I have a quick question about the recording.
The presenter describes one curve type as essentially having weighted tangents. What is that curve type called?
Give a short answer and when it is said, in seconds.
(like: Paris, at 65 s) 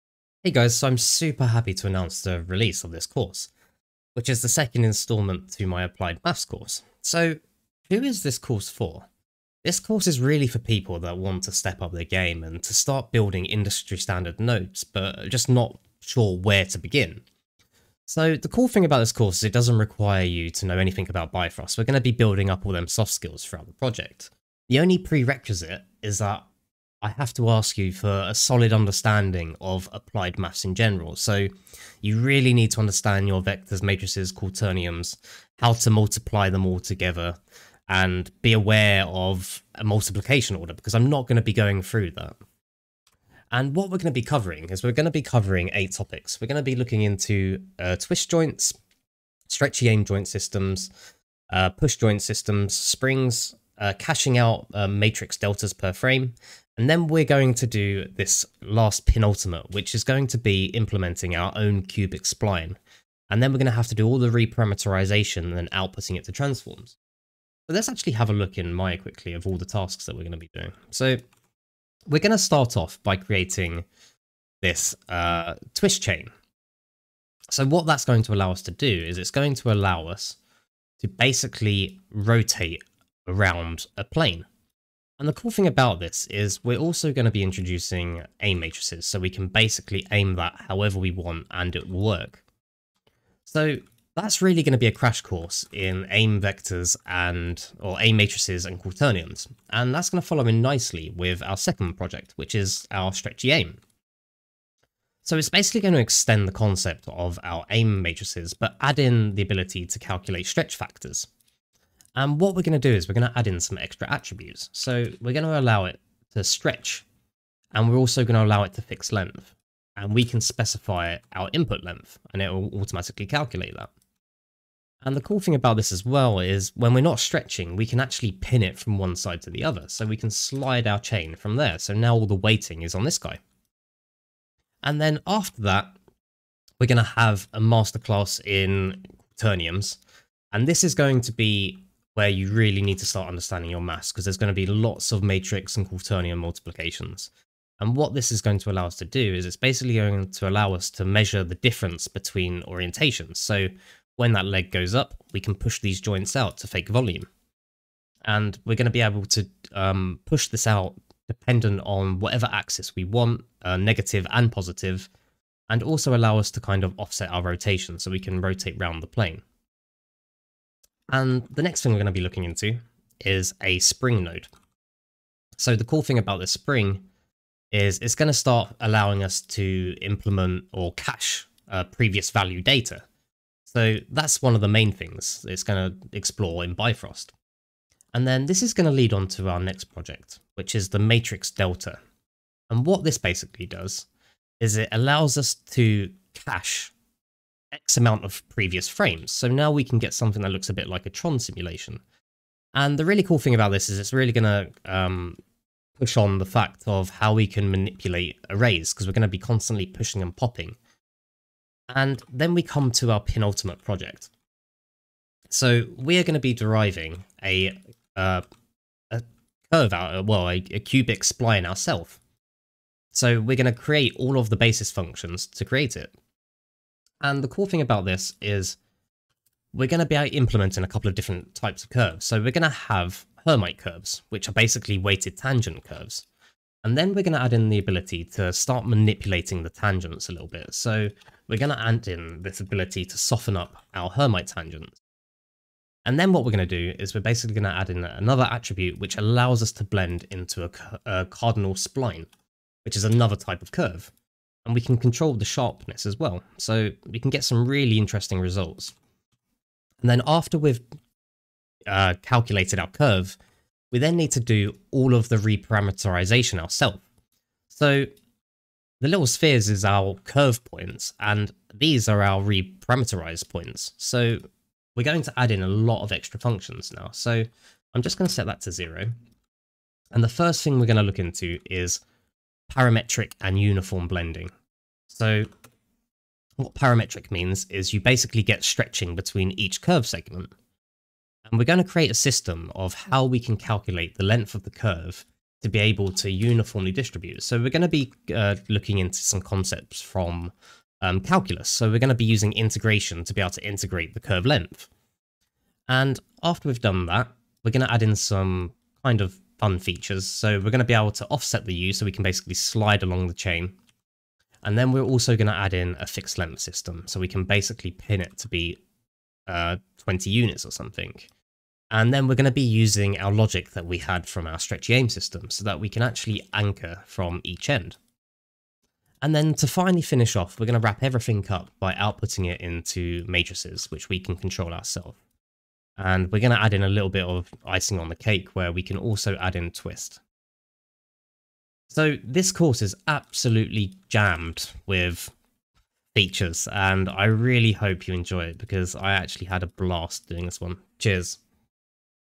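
Hermite curves, at 233 s.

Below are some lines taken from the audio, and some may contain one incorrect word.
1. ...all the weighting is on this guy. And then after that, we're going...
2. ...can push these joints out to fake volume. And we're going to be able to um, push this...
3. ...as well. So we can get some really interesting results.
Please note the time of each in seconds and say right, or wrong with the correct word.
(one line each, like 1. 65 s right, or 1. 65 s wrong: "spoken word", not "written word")
1. 132 s right
2. 155 s right
3. 256 s right.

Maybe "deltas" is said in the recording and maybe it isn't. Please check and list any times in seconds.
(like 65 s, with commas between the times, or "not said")
55 s, 191 s.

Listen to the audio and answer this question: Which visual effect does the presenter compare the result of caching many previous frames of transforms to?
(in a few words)
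Tron simulation.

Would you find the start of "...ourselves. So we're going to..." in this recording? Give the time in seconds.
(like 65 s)
221 s.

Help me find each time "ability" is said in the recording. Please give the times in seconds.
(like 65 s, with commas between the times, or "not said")
109 s, 237 s, 242 s.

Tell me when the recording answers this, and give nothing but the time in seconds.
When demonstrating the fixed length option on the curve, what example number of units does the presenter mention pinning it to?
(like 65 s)
319 s.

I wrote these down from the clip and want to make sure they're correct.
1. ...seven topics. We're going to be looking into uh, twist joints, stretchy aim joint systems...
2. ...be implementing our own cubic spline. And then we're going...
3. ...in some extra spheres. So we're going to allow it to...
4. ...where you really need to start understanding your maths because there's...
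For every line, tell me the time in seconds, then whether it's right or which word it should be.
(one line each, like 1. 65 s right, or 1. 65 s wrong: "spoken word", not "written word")
1. 45 s wrong: "eight", not "seven"
2. 60 s right
3. 113 s wrong: "attributes", not "spheres"
4. 142 s right.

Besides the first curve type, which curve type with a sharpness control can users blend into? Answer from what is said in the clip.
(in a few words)
Cardinal spline.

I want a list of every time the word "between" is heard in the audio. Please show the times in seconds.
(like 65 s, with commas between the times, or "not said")
152 s, 289 s.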